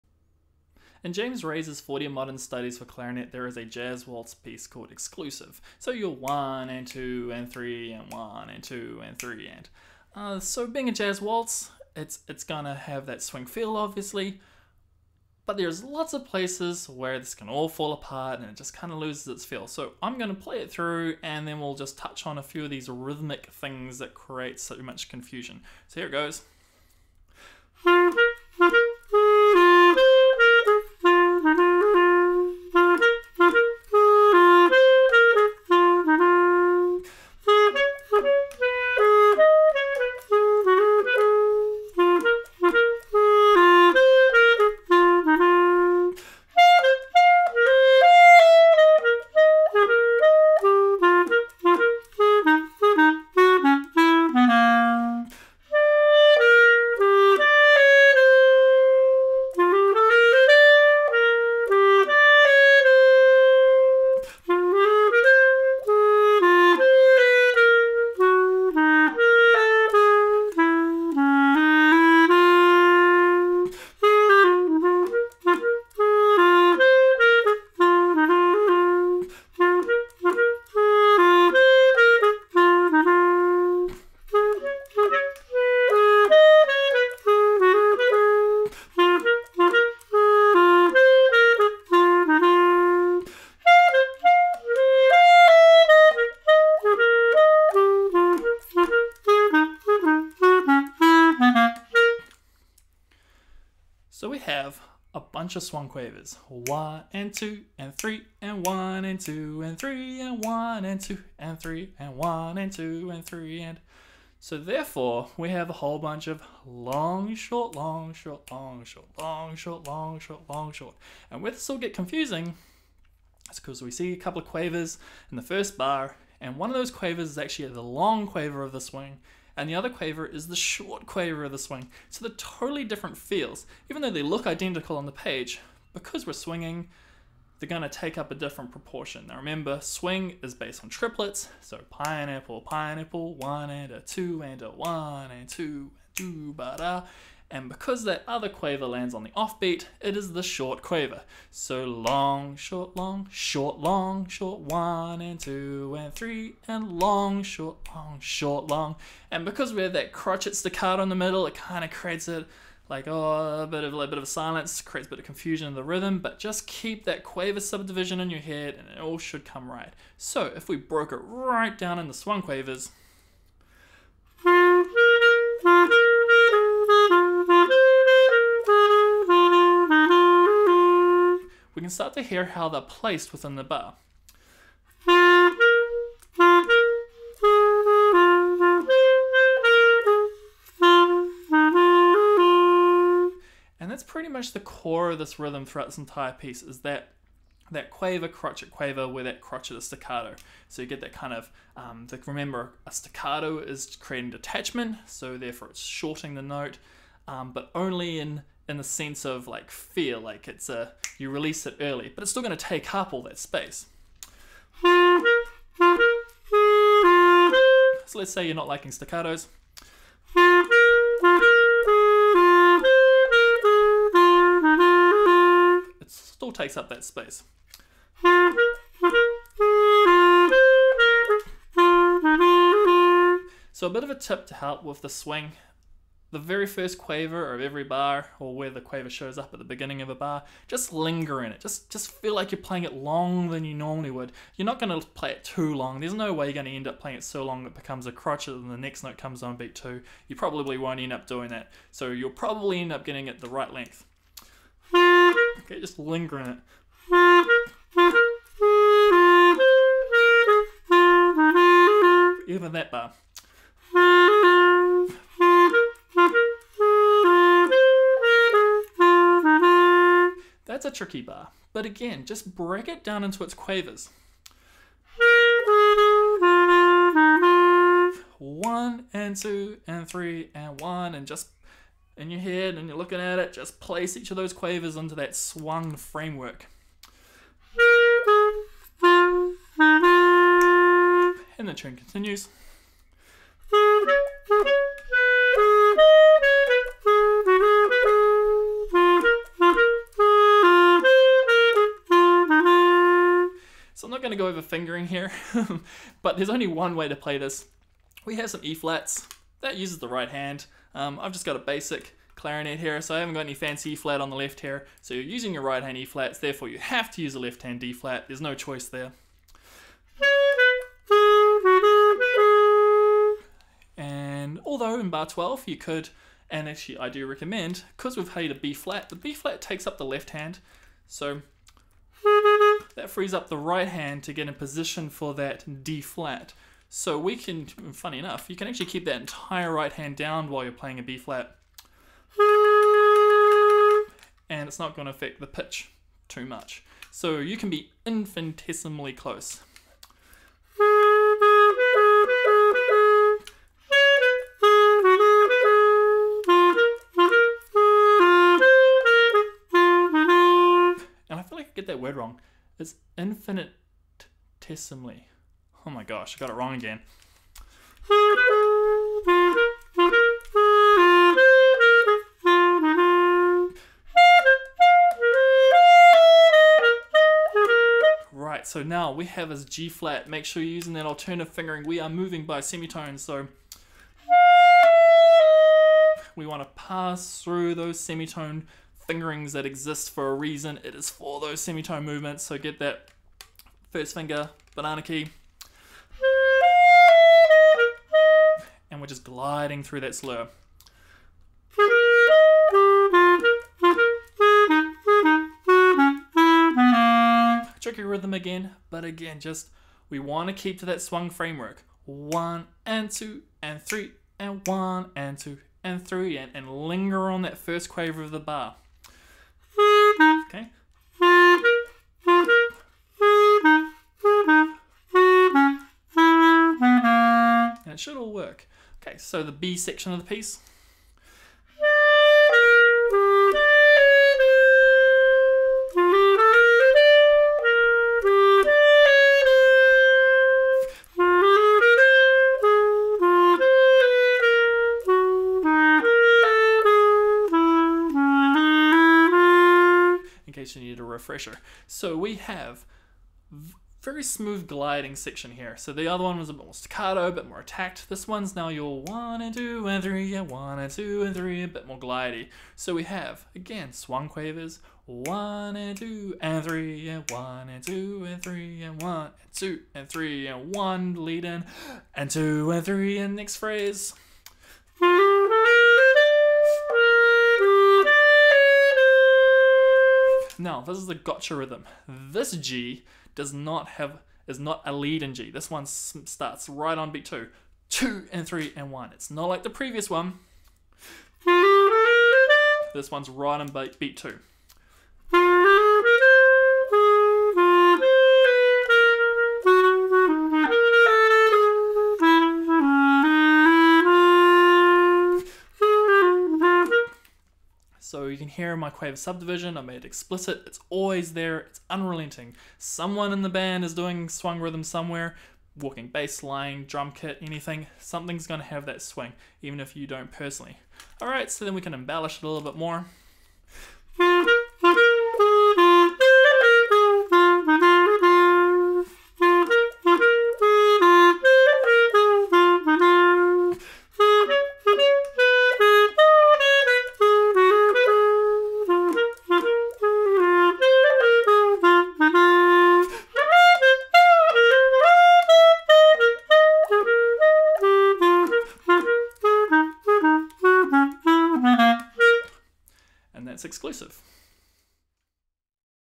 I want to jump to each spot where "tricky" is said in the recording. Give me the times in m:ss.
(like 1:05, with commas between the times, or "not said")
4:30, 6:47.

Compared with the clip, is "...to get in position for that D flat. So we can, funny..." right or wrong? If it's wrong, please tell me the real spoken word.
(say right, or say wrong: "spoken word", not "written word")
right.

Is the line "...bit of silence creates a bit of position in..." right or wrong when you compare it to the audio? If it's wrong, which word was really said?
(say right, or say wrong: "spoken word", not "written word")
wrong: "confusion", not "position".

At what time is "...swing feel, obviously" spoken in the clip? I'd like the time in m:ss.
0:13.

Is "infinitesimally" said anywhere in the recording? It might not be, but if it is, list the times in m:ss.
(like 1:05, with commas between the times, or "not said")
5:48, 6:03.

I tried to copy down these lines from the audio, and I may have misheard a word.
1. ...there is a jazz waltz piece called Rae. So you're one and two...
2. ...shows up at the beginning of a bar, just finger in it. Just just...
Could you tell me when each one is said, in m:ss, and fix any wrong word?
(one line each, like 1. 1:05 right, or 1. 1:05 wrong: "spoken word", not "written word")
1. 0:03 wrong: "Exclusive", not "Rae"
2. 3:59 wrong: "linger", not "finger".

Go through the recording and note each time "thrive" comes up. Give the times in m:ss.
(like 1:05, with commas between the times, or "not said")
not said.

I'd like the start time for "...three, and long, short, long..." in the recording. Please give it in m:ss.
2:36.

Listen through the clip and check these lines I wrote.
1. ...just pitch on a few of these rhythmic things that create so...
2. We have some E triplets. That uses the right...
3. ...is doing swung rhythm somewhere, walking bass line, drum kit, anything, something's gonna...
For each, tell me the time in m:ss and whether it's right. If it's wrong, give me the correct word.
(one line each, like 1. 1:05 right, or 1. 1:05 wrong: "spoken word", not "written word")
1. 0:21 wrong: "touch", not "pitch"
2. 5:08 wrong: "flats", not "triplets"
3. 8:33 right.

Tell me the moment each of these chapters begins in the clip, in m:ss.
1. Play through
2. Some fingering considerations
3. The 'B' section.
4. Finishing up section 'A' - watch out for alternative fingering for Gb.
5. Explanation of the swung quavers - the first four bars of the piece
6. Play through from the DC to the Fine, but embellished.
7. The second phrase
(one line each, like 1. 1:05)
1. 0:27
2. 5:03
3. 7:08
4. 6:07
5. 1:43
6. 8:43
7. 4:53.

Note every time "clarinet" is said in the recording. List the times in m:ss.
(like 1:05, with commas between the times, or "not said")
0:02, 5:12.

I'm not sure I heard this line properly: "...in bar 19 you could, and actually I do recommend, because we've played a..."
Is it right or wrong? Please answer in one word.
wrong.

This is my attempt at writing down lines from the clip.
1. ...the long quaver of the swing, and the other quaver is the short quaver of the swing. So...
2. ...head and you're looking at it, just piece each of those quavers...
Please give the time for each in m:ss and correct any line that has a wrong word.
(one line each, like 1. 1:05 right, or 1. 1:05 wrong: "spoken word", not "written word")
1. 2:07 right
2. 4:42 wrong: "place", not "piece".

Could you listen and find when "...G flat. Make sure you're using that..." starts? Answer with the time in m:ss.
6:19.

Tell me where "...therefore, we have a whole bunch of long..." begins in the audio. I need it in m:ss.
1:54.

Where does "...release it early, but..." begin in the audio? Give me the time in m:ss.
3:31.